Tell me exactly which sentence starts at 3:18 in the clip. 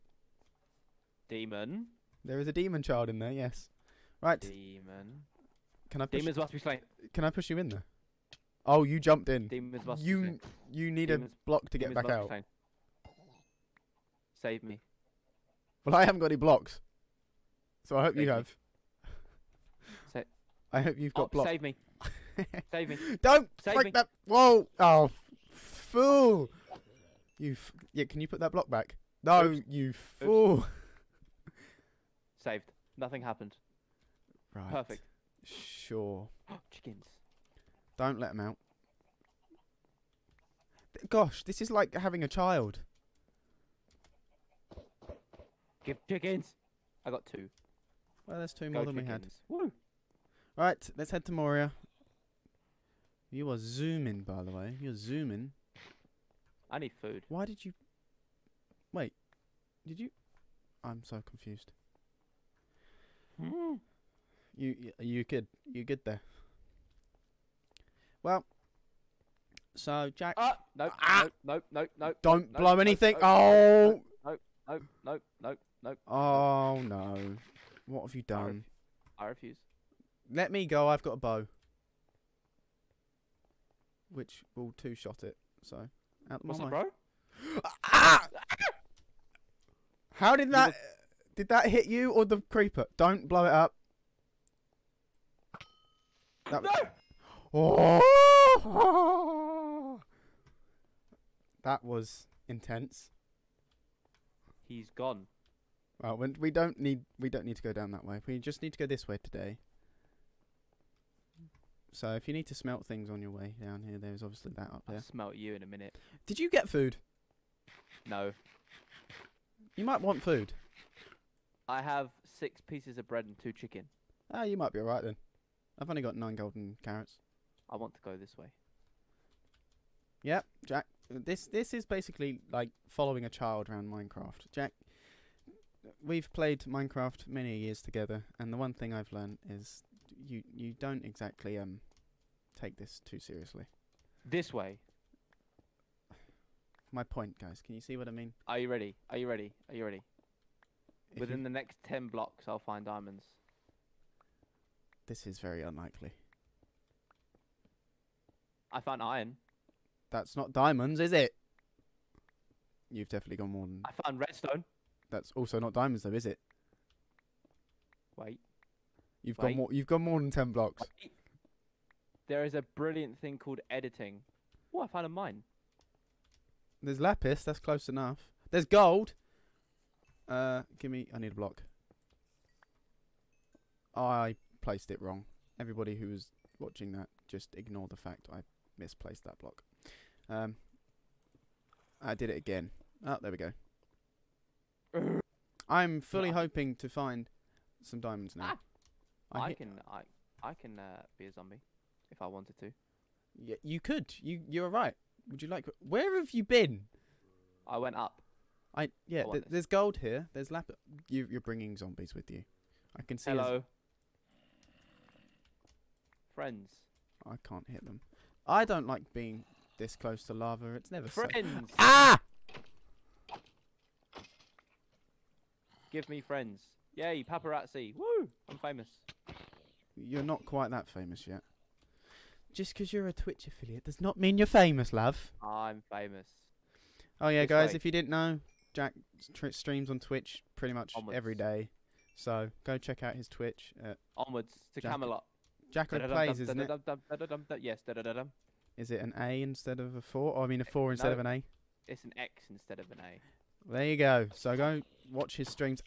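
Ah, I, I can I I can uh, be a zombie if I wanted to.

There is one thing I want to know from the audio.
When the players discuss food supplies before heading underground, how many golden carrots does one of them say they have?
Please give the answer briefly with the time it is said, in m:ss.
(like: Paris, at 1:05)
9, at 2:06.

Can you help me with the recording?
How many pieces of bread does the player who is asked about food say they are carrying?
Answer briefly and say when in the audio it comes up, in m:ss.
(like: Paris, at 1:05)
6, at 2:02.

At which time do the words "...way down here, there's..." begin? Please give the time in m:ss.
1:53.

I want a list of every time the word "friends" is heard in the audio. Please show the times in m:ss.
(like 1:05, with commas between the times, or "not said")
3:36, 3:41, 3:46.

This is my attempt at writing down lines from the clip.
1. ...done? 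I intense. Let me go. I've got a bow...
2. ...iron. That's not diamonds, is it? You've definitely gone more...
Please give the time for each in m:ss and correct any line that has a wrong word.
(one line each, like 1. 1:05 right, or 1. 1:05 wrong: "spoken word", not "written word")
1. 1:18 wrong: "refuse", not "intense"
2. 2:39 right.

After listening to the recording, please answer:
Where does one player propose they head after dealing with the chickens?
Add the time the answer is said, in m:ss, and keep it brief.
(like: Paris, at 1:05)
Moria, at 0:51.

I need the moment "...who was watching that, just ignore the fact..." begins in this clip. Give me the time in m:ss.
3:05.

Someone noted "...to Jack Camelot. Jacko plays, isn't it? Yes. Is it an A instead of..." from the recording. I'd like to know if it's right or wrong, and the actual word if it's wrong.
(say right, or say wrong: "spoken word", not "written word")
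right.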